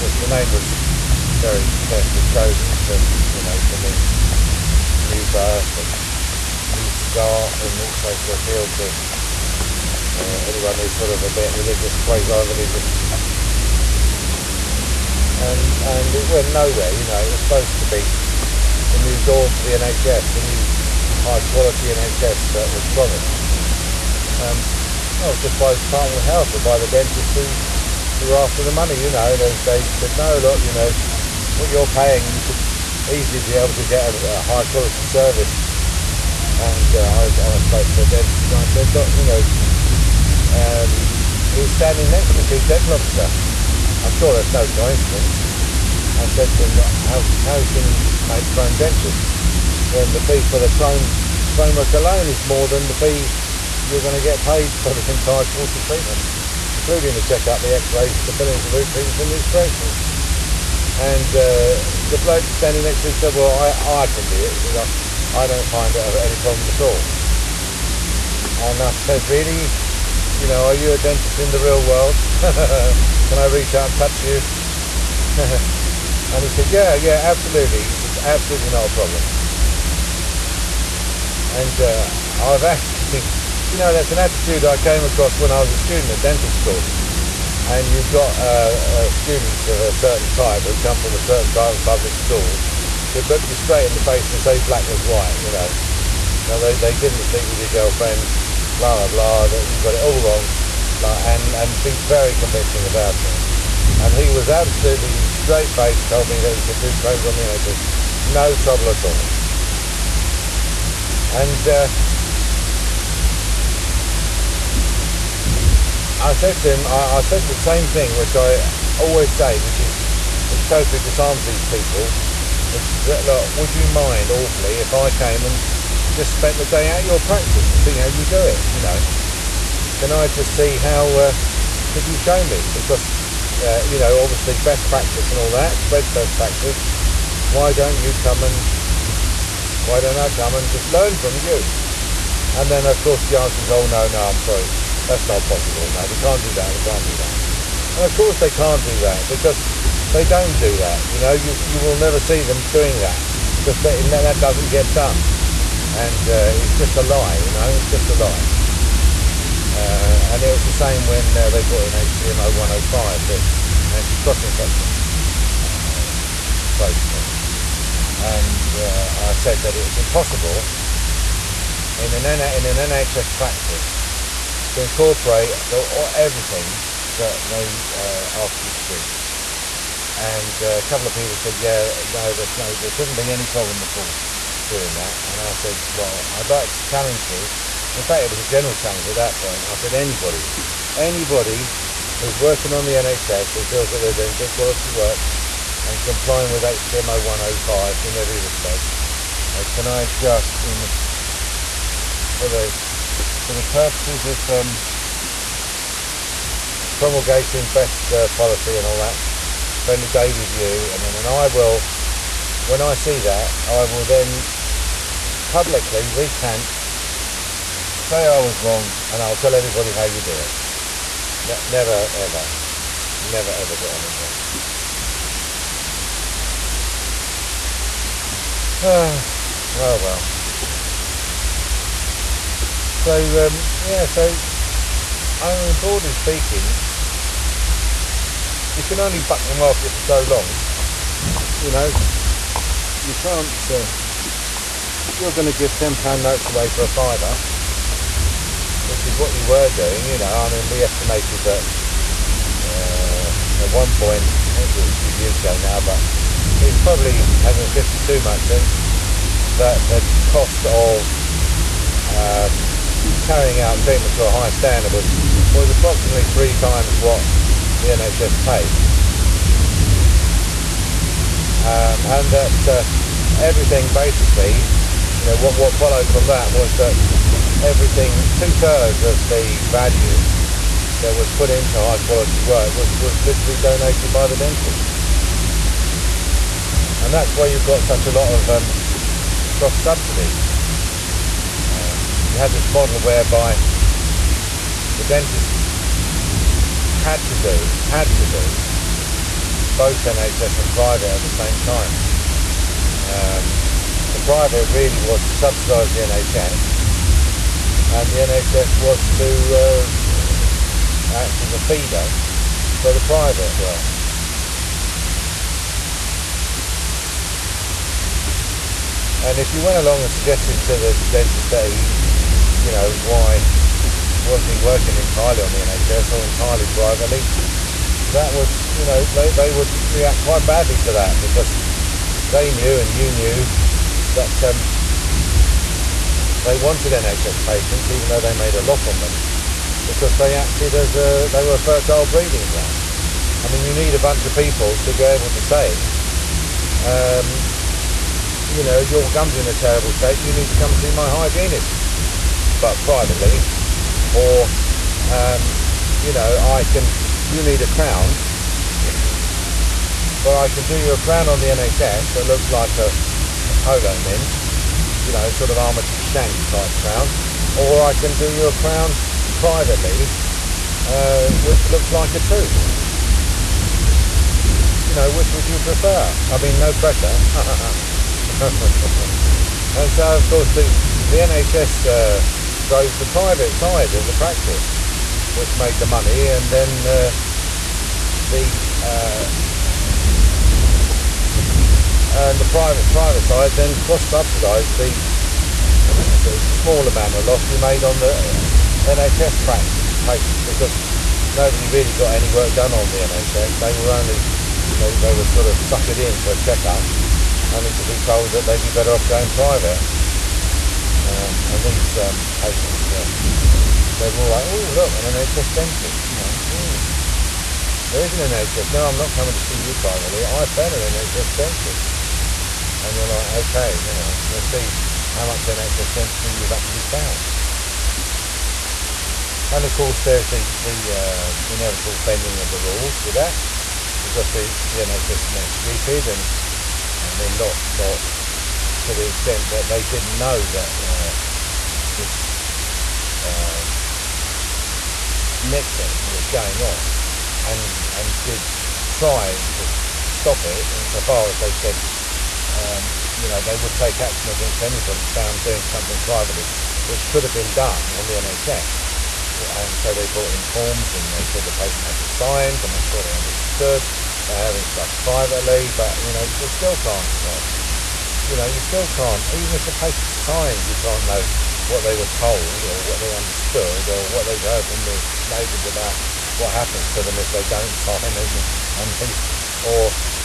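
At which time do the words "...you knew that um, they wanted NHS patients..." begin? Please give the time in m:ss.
5:32.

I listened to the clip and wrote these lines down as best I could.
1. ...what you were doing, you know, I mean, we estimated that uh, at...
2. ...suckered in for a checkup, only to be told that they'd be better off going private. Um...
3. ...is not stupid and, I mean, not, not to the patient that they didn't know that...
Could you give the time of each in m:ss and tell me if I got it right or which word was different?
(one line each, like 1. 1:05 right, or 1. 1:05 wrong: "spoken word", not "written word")
1. 4:09 right
2. 6:45 right
3. 7:15 wrong: "extent", not "patient".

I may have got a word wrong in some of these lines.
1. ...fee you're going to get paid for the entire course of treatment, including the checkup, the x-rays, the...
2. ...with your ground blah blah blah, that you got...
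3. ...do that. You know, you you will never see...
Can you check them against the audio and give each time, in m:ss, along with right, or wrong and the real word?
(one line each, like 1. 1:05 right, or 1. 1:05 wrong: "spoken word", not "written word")
1. 0:52 right
2. 1:37 wrong: "girlfriend", not "ground"
3. 2:30 right.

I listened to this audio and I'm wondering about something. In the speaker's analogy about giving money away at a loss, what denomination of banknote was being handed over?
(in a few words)
£10 notes.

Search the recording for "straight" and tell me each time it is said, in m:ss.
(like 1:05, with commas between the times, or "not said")
1:33, 1:45.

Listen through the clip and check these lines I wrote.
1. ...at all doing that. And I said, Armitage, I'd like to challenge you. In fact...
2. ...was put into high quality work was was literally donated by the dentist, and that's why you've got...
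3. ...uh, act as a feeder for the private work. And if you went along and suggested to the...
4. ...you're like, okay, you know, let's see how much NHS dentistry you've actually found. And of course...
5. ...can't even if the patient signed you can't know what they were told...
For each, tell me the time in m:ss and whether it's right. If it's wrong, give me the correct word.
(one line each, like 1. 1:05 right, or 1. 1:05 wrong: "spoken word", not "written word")
1. 3:03 wrong: "Well", not "Armitage"
2. 4:41 right
3. 5:09 right
4. 7:02 right
5. 7:48 right.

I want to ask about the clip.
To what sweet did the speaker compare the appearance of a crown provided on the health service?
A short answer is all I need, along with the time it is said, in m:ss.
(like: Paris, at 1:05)
a polo mint, at 6:02.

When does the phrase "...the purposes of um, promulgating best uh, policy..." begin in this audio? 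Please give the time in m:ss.
3:23.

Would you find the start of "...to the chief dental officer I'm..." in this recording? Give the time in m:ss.
0:42.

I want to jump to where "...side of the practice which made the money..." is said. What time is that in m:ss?
6:23.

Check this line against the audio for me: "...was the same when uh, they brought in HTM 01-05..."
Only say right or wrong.
right.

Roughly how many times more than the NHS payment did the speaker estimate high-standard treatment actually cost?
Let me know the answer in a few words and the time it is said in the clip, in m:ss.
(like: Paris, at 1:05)
3 times, at 4:26.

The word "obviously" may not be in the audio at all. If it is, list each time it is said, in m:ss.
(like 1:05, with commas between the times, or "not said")
2:14, 4:14.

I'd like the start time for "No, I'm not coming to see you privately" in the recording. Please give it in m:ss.
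6:58.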